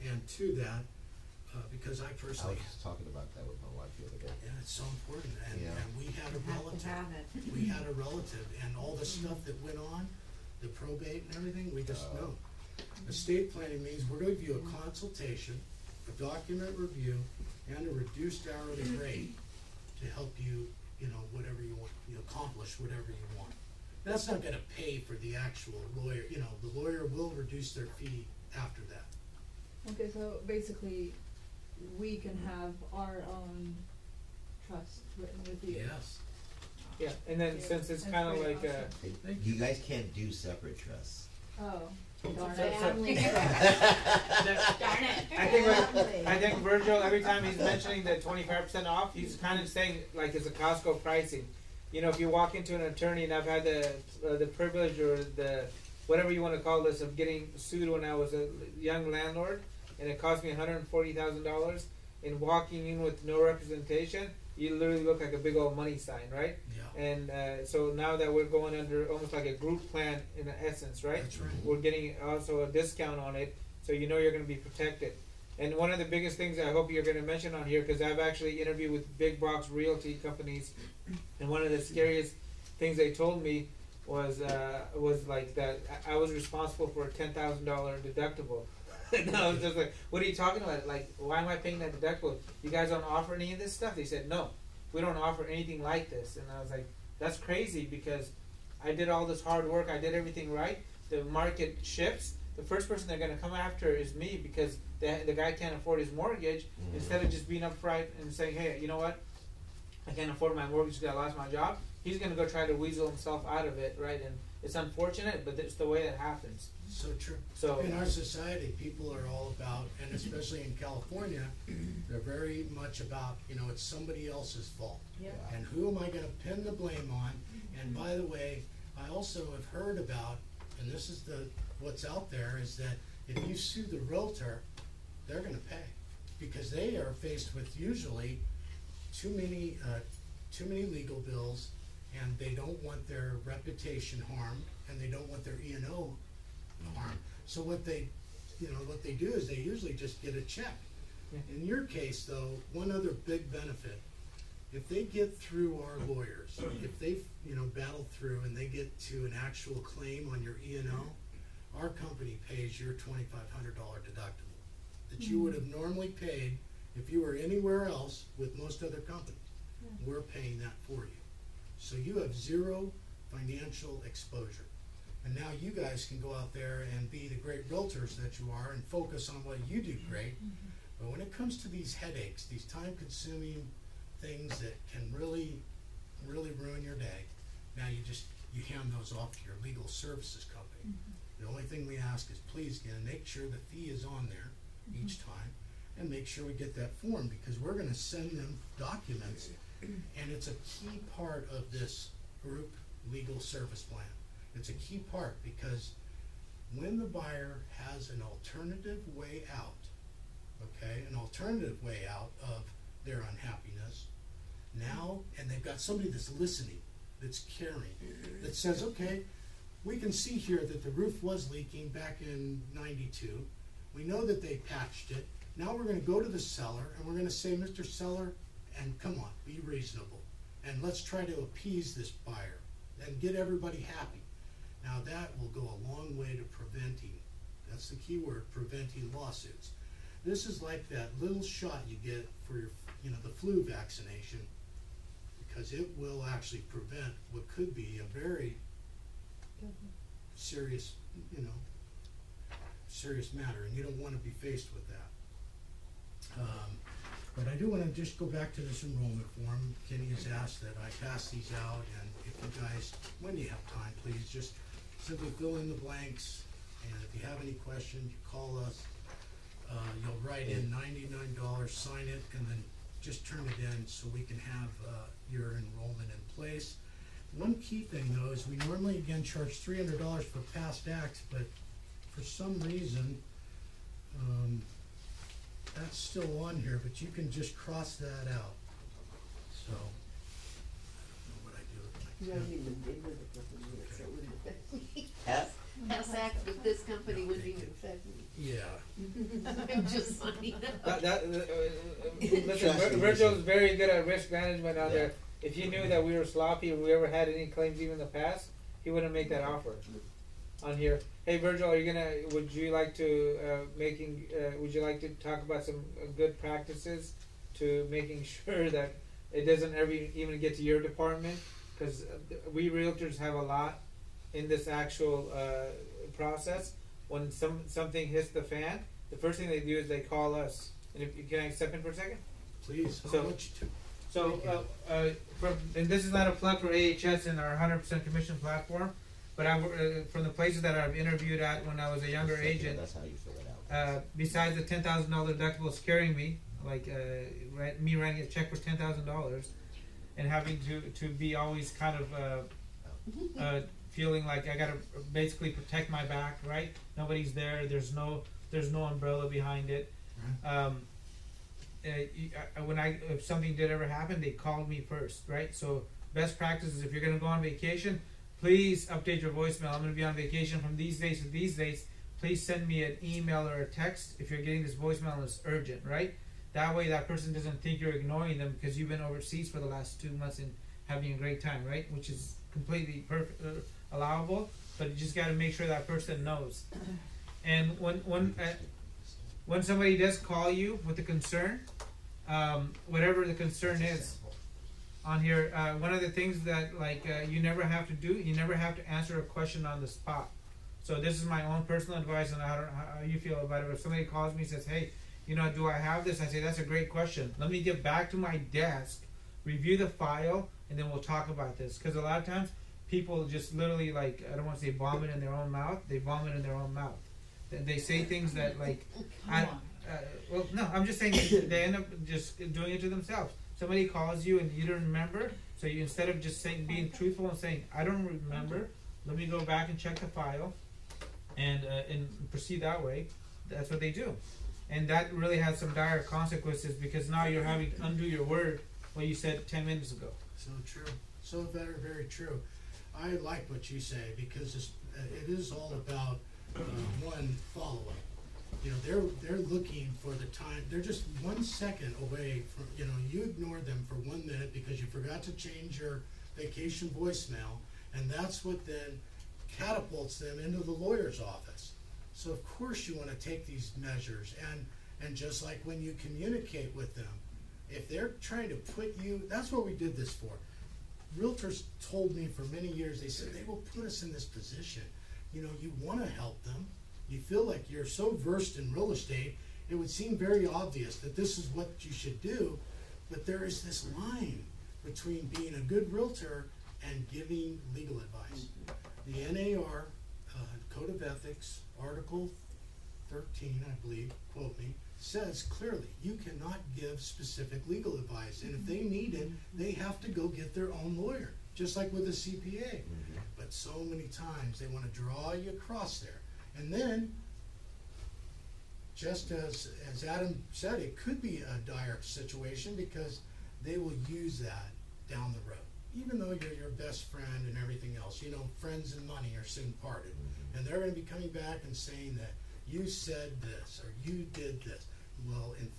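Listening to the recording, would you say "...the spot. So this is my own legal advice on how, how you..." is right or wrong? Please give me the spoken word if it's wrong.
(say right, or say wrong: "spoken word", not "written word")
wrong: "personal", not "legal".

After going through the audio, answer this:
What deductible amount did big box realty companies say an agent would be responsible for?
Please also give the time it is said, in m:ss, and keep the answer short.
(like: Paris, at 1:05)
$10,000, at 1:27.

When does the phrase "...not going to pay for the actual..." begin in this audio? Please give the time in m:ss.
0:24.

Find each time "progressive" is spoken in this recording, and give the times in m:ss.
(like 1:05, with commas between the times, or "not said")
not said.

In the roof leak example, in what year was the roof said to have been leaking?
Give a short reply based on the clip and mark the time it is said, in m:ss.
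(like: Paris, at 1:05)
1992, at 3:42.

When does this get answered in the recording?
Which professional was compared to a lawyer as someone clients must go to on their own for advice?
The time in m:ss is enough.
8:22.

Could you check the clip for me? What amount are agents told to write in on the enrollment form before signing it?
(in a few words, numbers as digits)
$99.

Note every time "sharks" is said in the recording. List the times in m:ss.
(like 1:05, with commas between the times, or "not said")
not said.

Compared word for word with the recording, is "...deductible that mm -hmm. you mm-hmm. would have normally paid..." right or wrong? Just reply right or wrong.
right.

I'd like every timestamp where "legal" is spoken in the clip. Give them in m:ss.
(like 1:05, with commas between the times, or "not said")
2:20, 3:09, 3:23, 8:07, 8:17.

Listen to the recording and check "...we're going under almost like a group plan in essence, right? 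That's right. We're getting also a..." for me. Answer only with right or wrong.
right.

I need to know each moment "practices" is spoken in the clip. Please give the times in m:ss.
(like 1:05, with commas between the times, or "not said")
5:16, 6:06.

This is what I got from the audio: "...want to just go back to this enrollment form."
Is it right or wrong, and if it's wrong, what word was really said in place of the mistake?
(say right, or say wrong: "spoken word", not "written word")
right.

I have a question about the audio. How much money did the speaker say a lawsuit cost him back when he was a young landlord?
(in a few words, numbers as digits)
$140,000.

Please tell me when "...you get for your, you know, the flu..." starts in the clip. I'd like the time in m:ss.
4:01.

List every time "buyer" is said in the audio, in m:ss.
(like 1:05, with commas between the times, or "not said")
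3:27, 3:52.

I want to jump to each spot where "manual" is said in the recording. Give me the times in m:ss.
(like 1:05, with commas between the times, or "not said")
not said.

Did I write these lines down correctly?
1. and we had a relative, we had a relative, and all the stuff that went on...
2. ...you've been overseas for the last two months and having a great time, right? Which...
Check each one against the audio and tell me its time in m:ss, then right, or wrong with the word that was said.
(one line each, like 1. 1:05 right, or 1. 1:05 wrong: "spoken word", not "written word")
1. 0:05 right
2. 6:18 right.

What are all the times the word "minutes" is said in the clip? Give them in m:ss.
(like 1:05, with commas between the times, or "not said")
7:19, 7:34.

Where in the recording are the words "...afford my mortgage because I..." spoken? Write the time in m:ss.
1:50.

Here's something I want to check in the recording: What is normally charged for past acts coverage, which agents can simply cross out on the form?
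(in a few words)
$300.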